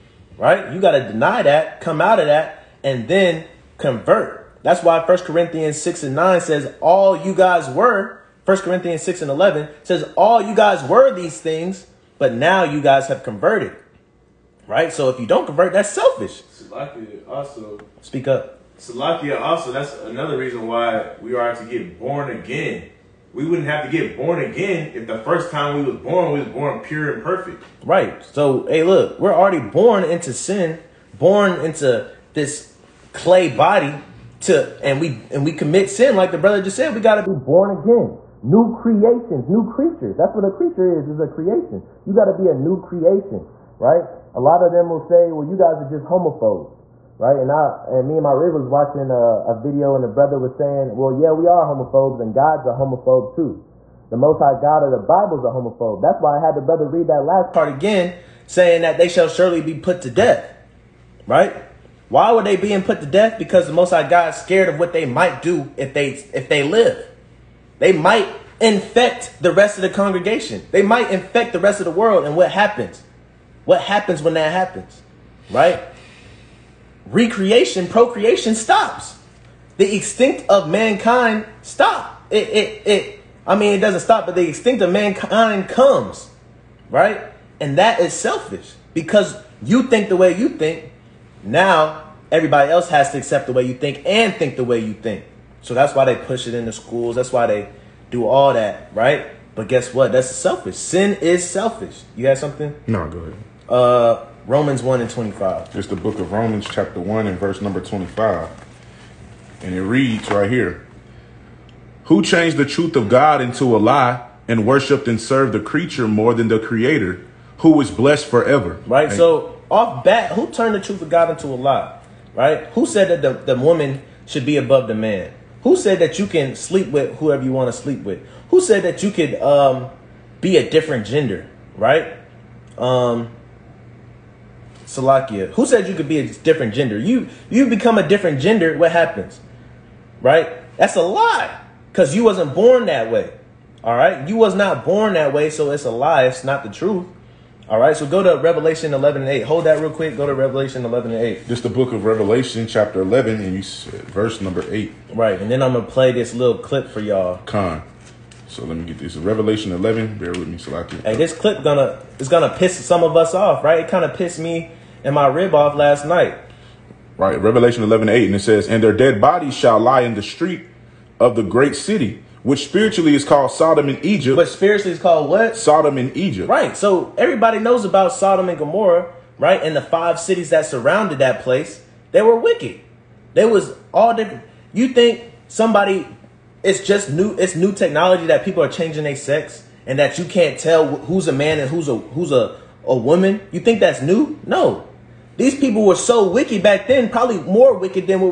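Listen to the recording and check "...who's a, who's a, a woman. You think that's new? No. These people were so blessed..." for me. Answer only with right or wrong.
wrong.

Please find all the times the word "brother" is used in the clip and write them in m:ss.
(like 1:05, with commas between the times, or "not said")
0:36, 0:50, 0:56.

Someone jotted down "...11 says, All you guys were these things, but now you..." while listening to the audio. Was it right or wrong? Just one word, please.
right.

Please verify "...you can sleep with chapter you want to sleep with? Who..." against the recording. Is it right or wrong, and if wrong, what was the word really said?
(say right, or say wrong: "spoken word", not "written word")
wrong: "whoever", not "chapter".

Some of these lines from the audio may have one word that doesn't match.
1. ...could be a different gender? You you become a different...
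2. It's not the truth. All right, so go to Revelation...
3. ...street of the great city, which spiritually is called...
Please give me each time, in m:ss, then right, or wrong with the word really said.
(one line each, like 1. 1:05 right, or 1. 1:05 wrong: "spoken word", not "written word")
1. 2:15 right
2. 2:26 right
3. 2:50 right.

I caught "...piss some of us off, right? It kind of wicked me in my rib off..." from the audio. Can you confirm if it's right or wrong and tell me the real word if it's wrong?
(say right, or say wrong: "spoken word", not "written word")
wrong: "pissed", not "wicked".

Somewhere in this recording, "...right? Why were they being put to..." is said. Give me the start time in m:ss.
1:01.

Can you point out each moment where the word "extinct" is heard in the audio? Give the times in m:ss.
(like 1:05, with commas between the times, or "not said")
1:19, 1:24.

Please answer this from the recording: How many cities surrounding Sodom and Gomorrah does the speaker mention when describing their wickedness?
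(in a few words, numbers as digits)
5.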